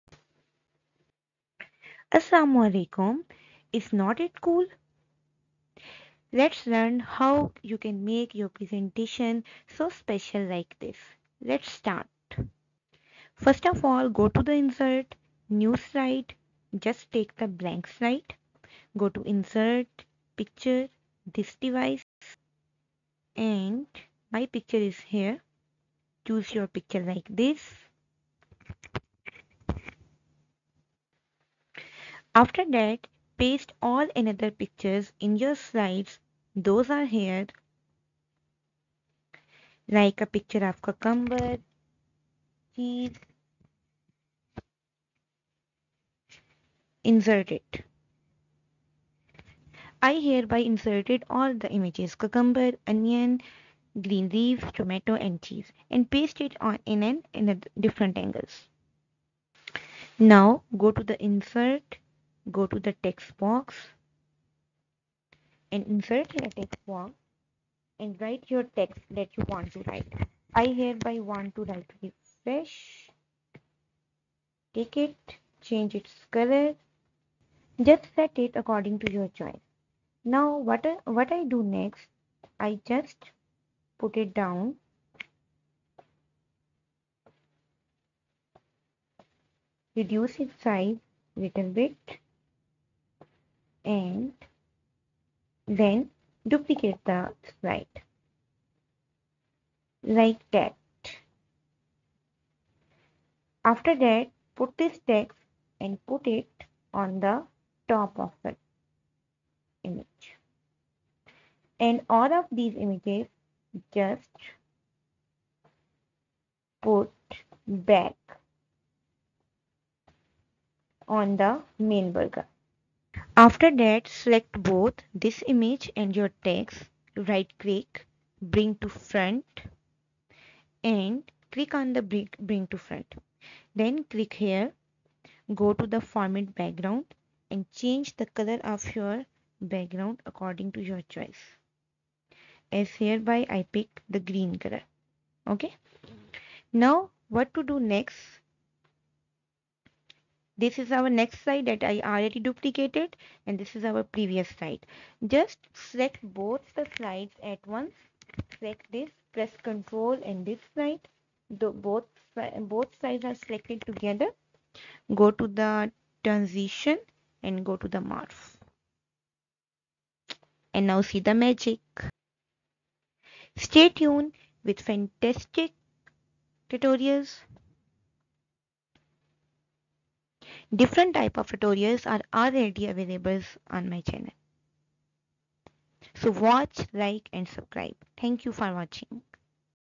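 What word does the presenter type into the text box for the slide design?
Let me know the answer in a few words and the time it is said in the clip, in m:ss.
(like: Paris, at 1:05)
Refresh, at 1:12.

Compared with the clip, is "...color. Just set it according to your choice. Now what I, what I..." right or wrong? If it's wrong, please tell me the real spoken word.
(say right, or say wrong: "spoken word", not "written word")
right.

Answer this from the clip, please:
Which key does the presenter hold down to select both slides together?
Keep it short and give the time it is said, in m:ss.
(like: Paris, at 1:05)
Control, at 2:39.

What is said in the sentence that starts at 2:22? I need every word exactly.
As hereby I pick the green color.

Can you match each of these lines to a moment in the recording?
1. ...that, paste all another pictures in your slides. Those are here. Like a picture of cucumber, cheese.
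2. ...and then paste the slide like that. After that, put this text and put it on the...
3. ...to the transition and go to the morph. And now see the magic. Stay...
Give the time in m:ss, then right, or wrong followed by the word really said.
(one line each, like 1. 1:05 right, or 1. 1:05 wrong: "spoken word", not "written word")
1. 0:32 right
2. 1:33 wrong: "duplicate", not "paste"
3. 2:45 right.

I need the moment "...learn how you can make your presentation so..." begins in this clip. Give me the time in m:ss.
0:06.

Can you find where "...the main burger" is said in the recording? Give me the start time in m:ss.
2:01.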